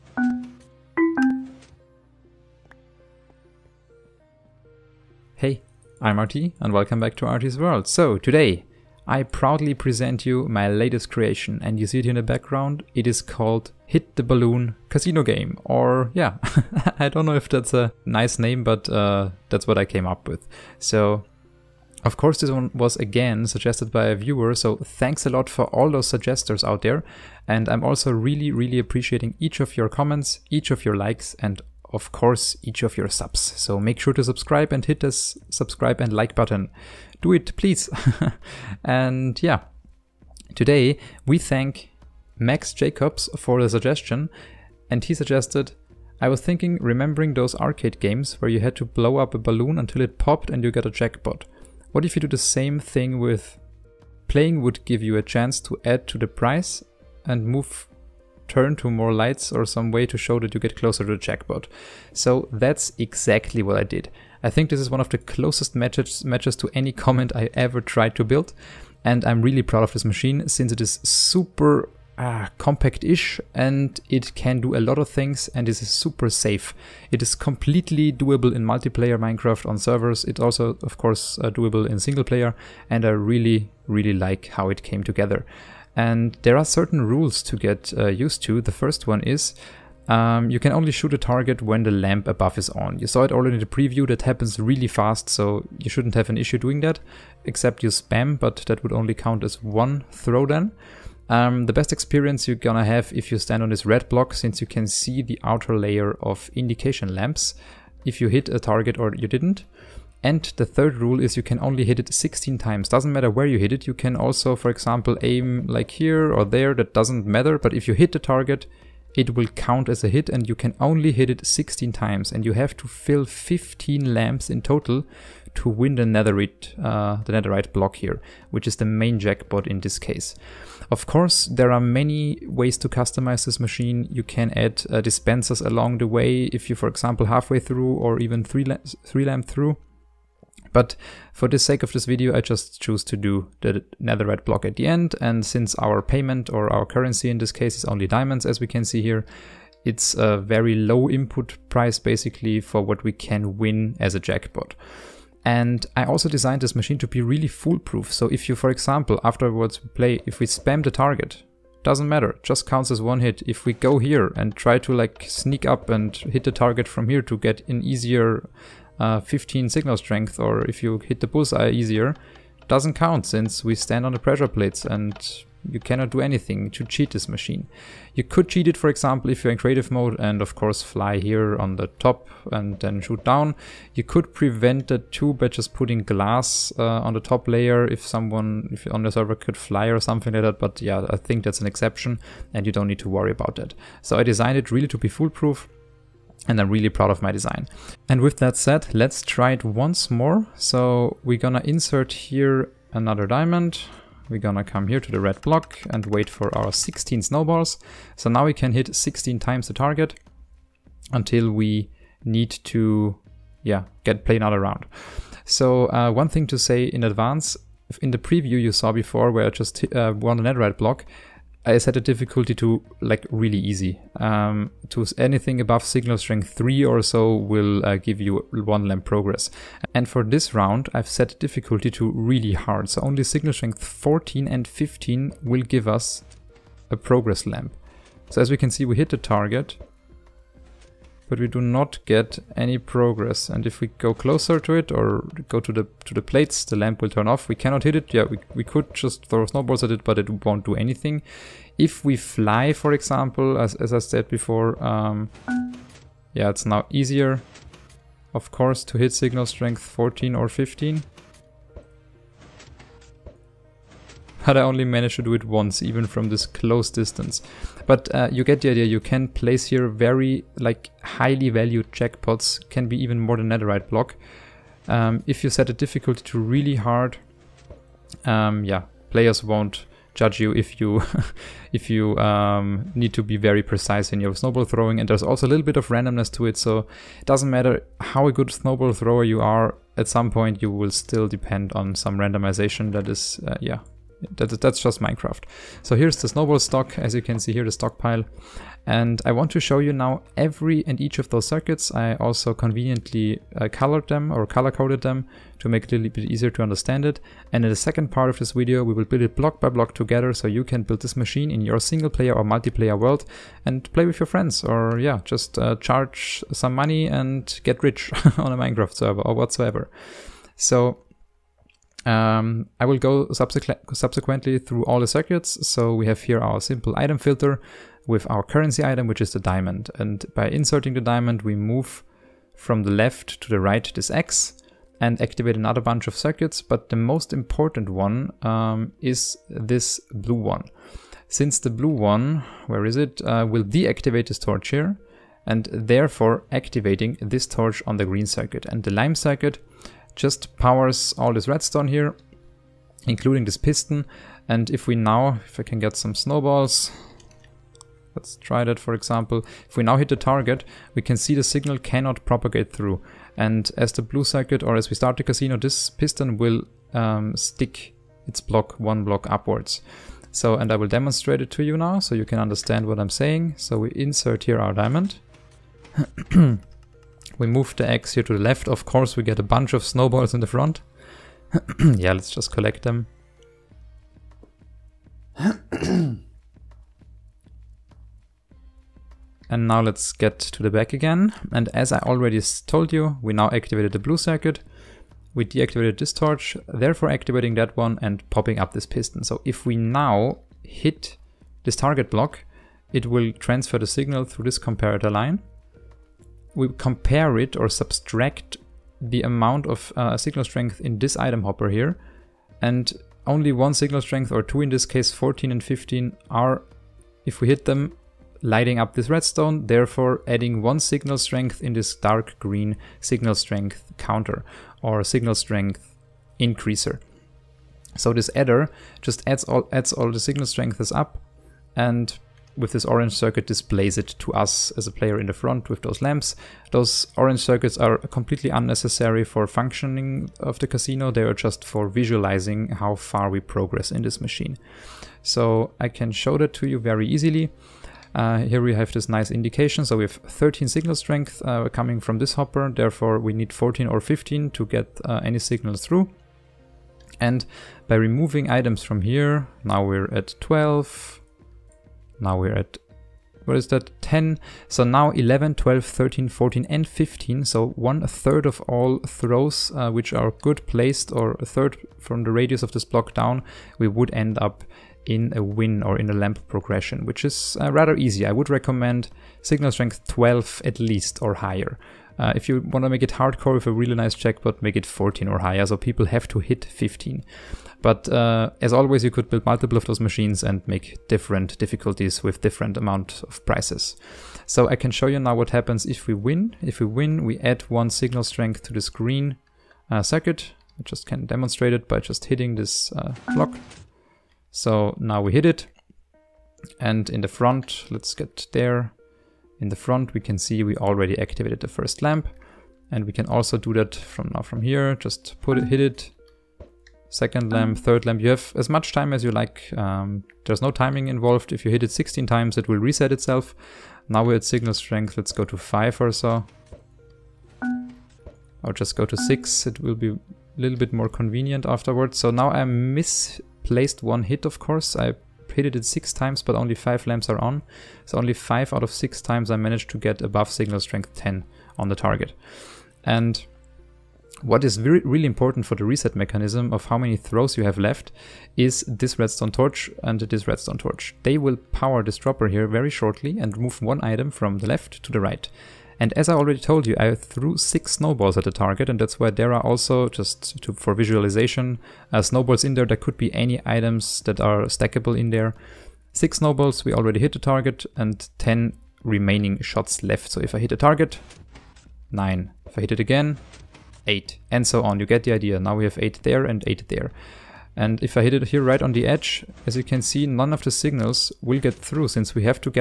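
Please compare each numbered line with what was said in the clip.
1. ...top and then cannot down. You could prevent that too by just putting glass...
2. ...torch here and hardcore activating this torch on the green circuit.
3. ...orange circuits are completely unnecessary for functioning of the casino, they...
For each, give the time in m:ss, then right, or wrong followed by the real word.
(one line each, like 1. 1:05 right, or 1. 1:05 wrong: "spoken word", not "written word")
1. 3:01 wrong: "shoot", not "cannot"
2. 5:44 wrong: "therefore", not "hardcore"
3. 7:17 right.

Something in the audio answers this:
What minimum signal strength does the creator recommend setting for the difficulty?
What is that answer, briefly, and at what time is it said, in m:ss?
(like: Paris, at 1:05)
12, at 7:59.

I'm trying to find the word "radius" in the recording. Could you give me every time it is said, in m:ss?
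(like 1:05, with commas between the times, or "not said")
7:52.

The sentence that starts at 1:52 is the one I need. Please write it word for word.
Doesn't matter where you hit it.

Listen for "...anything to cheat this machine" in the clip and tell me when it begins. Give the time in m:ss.
2:56.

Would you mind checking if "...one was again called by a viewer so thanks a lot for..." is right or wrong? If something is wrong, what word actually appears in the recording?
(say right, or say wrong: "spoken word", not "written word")
wrong: "suggested", not "called".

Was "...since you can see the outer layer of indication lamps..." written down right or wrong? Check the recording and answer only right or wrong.
right.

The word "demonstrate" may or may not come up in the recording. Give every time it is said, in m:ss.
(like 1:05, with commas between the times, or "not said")
6:10, 8:21.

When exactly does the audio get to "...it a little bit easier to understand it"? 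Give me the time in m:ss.
5:05.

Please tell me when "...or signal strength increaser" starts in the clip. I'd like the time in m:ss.
7:04.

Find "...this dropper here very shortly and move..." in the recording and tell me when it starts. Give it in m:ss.
9:12.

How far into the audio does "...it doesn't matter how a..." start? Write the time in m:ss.
4:47.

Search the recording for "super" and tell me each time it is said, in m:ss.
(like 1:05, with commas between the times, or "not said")
1:11, 1:15.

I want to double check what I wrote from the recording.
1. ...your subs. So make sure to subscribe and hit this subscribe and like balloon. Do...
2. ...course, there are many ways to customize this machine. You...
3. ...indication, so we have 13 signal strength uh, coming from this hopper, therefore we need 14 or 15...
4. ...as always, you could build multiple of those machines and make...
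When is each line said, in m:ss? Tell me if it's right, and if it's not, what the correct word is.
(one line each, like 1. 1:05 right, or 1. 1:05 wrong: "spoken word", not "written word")
1. 0:32 wrong: "button", not "balloon"
2. 2:11 right
3. 7:29 right
4. 8:08 right.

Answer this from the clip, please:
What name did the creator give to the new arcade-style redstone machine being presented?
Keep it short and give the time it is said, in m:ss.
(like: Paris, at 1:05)
Hit the Balloon Casino Game, at 0:13.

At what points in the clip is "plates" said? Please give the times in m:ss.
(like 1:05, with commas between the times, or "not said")
2:54, 4:06.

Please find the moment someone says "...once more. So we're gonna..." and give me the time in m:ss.
3:19.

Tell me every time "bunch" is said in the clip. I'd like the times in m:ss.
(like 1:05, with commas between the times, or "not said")
5:35, 6:19.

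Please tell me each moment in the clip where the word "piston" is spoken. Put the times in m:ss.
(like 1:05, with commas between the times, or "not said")
5:53, 6:05, 6:38.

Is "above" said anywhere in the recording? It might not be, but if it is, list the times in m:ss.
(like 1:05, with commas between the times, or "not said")
1:32, 3:45, 9:00.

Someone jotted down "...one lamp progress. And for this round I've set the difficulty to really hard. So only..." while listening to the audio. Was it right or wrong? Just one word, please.
right.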